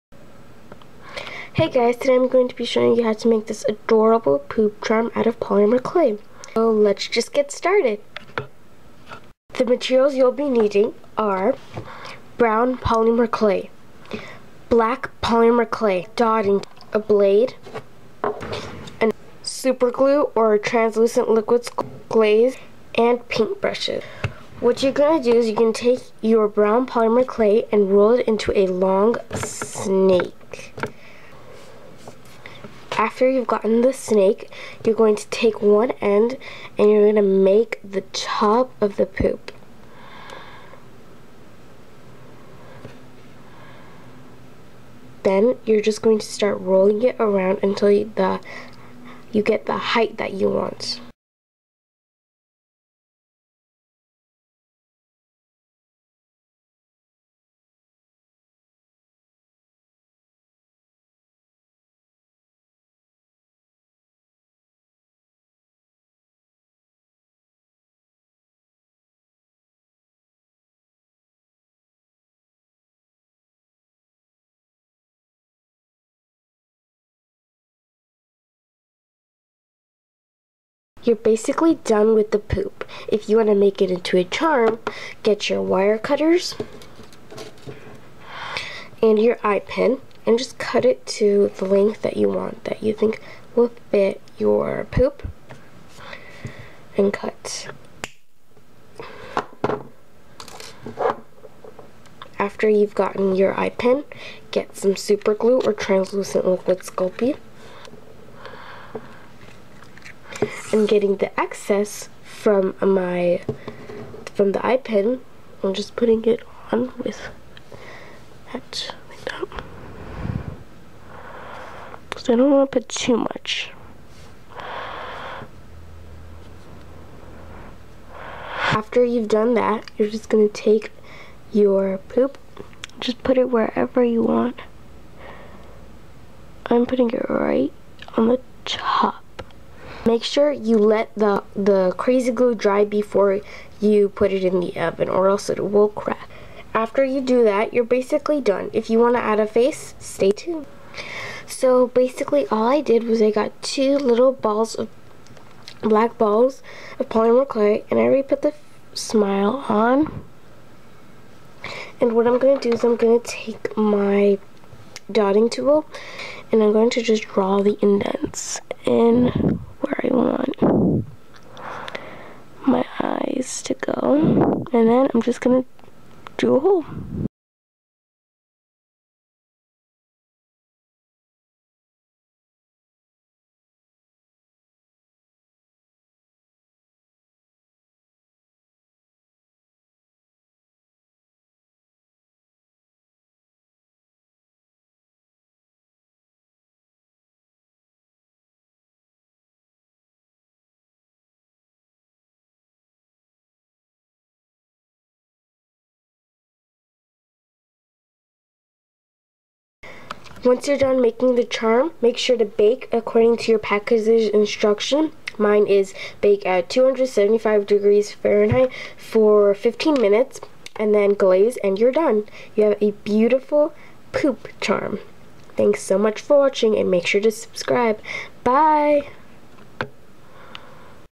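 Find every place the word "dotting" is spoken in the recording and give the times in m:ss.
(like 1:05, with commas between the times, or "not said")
0:16, 2:45.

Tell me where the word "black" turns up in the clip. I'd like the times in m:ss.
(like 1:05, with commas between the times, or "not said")
0:14, 2:35.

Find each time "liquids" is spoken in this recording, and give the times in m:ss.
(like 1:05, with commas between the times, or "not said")
0:21, 1:46.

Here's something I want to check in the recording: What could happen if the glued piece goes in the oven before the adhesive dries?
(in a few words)
it will crack.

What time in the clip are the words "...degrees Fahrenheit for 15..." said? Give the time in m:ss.
3:37.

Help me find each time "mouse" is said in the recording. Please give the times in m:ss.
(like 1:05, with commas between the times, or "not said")
not said.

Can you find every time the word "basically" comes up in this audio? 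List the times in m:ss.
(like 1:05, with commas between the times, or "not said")
1:21, 2:27, 2:31.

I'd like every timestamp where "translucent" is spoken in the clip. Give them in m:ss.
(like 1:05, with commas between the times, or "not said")
0:20, 1:45.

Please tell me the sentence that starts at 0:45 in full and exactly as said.
Then you're just going to start rolling it around until you, the, you get the height that you want.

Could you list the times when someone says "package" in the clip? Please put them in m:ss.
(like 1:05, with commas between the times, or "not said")
3:33.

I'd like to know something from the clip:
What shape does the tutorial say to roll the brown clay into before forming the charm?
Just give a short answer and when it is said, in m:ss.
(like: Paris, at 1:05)
long snake, at 0:28.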